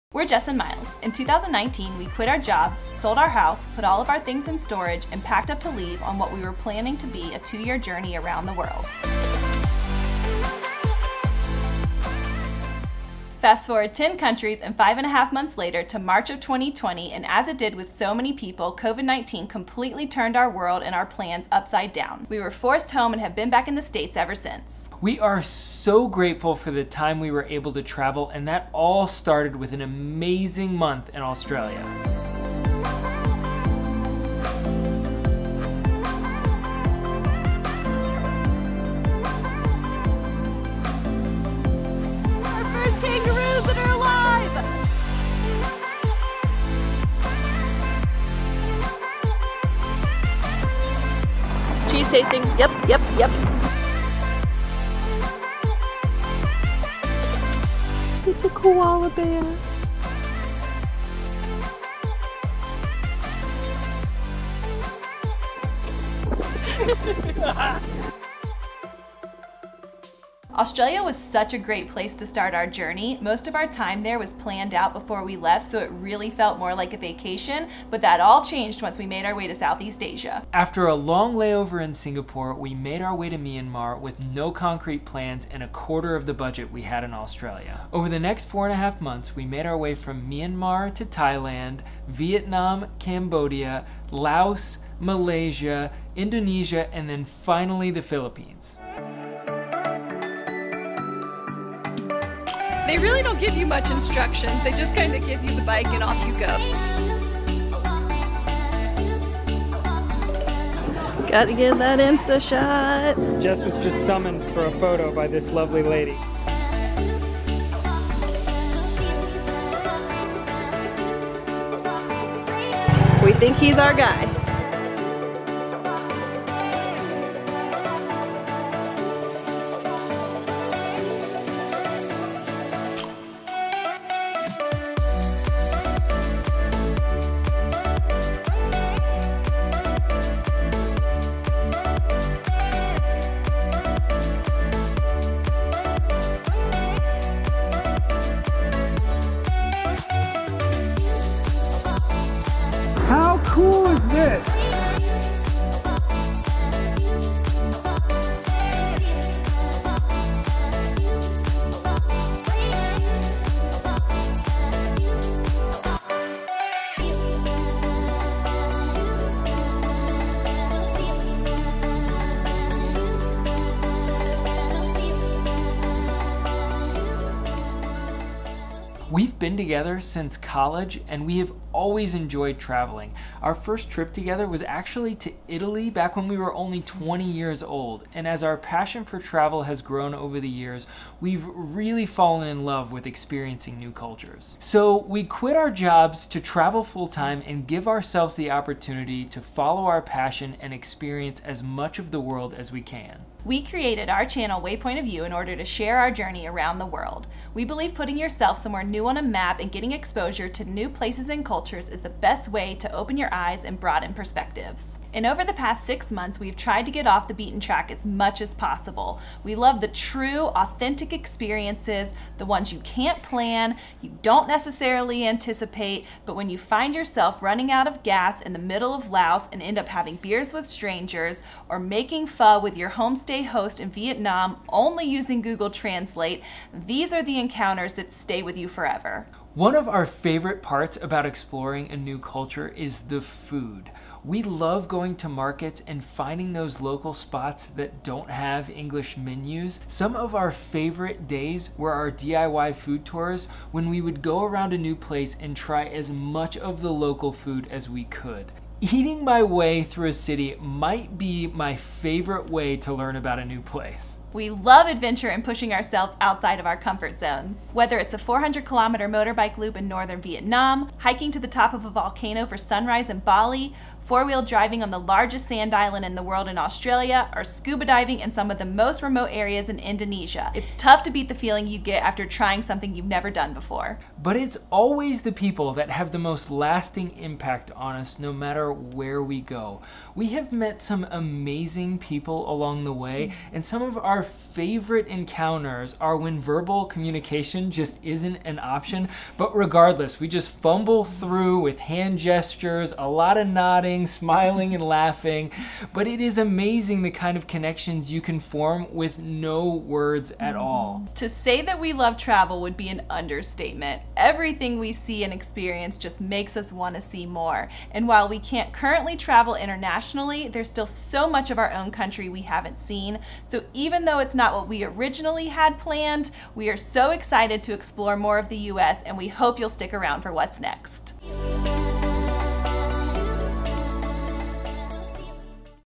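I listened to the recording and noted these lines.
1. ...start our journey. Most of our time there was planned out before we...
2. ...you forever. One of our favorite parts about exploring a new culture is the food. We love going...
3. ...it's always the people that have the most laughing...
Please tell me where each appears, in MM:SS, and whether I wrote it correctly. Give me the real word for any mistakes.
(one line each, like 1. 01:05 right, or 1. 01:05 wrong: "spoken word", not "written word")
1. 01:12 right
2. 03:58 right
3. 04:44 wrong: "lasting", not "laughing".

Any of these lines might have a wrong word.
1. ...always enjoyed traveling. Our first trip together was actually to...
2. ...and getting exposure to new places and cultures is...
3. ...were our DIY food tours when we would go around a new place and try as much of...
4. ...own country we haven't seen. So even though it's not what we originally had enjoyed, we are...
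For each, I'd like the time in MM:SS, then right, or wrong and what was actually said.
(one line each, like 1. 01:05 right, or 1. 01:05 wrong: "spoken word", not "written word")
1. 03:01 right
2. 03:29 right
3. 04:11 right
4. 05:21 wrong: "planned", not "enjoyed".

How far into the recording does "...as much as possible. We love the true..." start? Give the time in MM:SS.
03:37.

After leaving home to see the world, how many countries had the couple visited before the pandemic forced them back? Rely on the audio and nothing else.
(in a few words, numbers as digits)
10.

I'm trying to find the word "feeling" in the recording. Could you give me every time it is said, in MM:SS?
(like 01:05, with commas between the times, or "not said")
04:41.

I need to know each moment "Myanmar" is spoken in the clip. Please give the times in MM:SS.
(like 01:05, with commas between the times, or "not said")
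01:23, 01:30.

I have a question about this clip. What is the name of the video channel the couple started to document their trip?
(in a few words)
Waypoint of View.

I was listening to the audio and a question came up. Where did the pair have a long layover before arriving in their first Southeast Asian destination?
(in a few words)
Singapore.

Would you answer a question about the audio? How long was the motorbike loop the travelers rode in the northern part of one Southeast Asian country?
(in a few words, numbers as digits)
400 kilometers.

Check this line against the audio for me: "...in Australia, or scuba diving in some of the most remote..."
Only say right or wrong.
right.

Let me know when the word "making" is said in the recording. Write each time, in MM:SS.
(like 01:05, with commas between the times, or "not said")
03:51.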